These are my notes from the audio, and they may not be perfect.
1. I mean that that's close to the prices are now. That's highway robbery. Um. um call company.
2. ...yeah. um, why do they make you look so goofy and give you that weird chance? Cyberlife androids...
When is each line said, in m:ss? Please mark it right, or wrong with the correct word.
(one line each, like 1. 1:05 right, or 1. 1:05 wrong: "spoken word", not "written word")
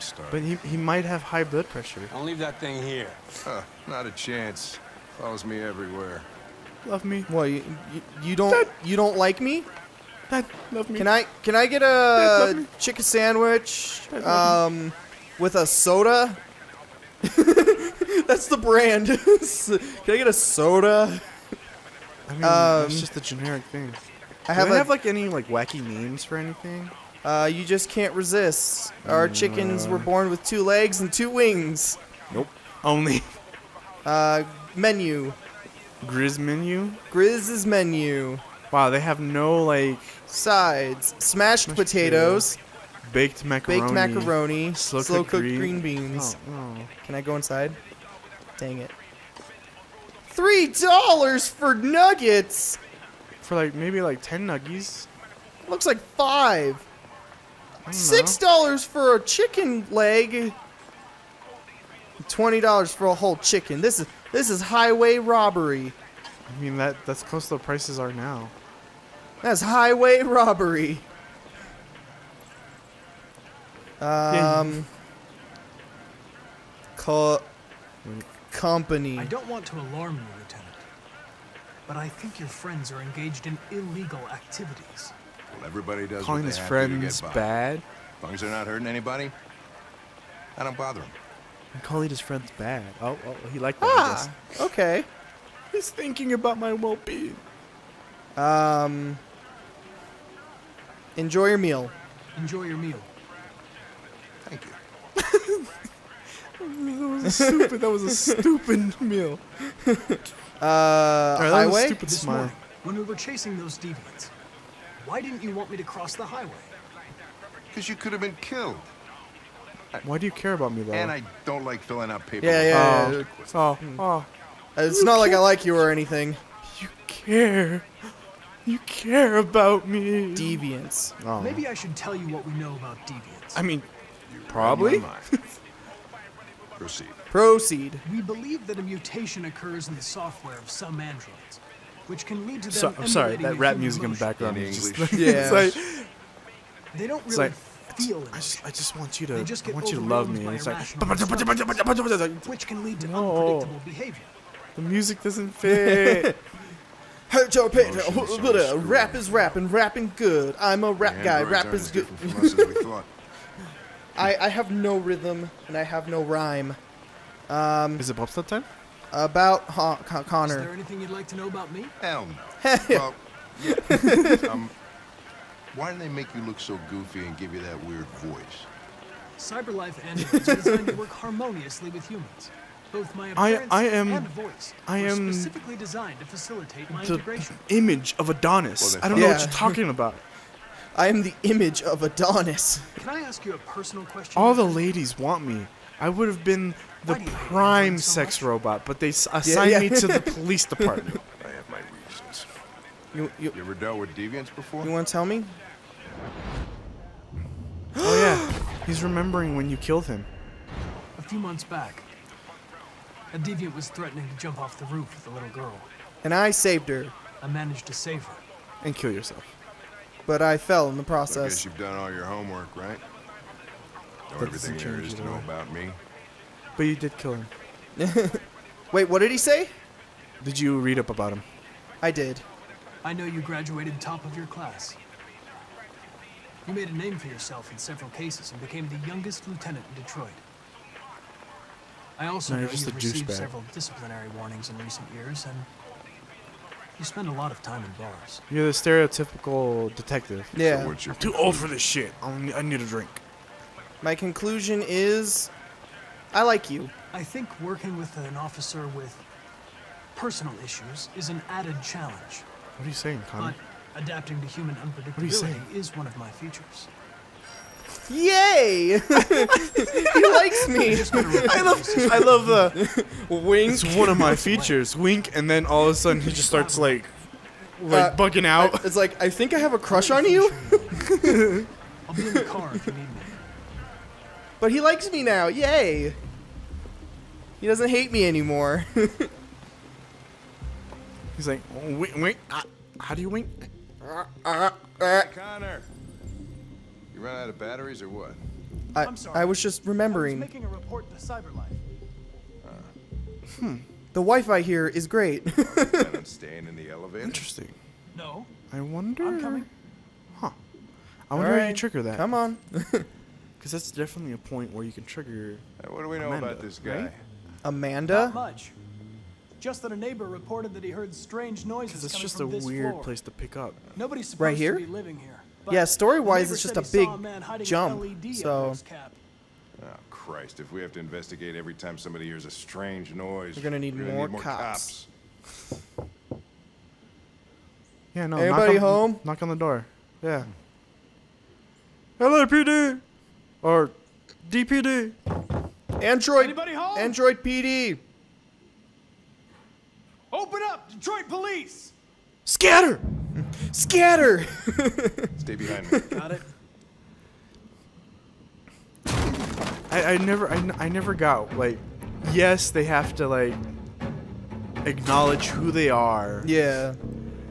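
1. 1:06 right
2. 2:53 wrong: "voice", not "chance".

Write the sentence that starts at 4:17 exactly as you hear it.
I think working with an officer with personal issues is an added challenge.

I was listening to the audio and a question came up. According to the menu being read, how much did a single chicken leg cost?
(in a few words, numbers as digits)
$6.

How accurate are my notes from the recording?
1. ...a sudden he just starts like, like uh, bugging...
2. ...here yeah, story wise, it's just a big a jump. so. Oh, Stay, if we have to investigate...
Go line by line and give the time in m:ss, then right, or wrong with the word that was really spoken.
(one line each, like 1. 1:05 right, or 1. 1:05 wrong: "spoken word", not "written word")
1. 4:35 right
2. 5:25 wrong: "Christ", not "Stay".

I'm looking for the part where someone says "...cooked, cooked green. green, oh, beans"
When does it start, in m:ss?
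0:45.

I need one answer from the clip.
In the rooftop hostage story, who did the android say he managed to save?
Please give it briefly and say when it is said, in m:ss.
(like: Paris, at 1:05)
a little girl, at 3:35.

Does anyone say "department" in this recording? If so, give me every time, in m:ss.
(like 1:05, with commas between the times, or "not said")
3:20.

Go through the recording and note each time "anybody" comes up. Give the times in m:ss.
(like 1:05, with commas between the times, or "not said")
1:28, 5:46.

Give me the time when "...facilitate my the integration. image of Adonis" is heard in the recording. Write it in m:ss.
3:06.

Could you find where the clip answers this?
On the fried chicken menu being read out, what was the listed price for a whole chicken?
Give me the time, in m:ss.
1:02.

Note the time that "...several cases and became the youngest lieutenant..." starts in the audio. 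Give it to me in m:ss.
3:57.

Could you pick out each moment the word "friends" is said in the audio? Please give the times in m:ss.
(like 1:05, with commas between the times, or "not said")
1:22, 1:26, 1:32.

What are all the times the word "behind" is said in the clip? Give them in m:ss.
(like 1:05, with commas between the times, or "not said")
5:55.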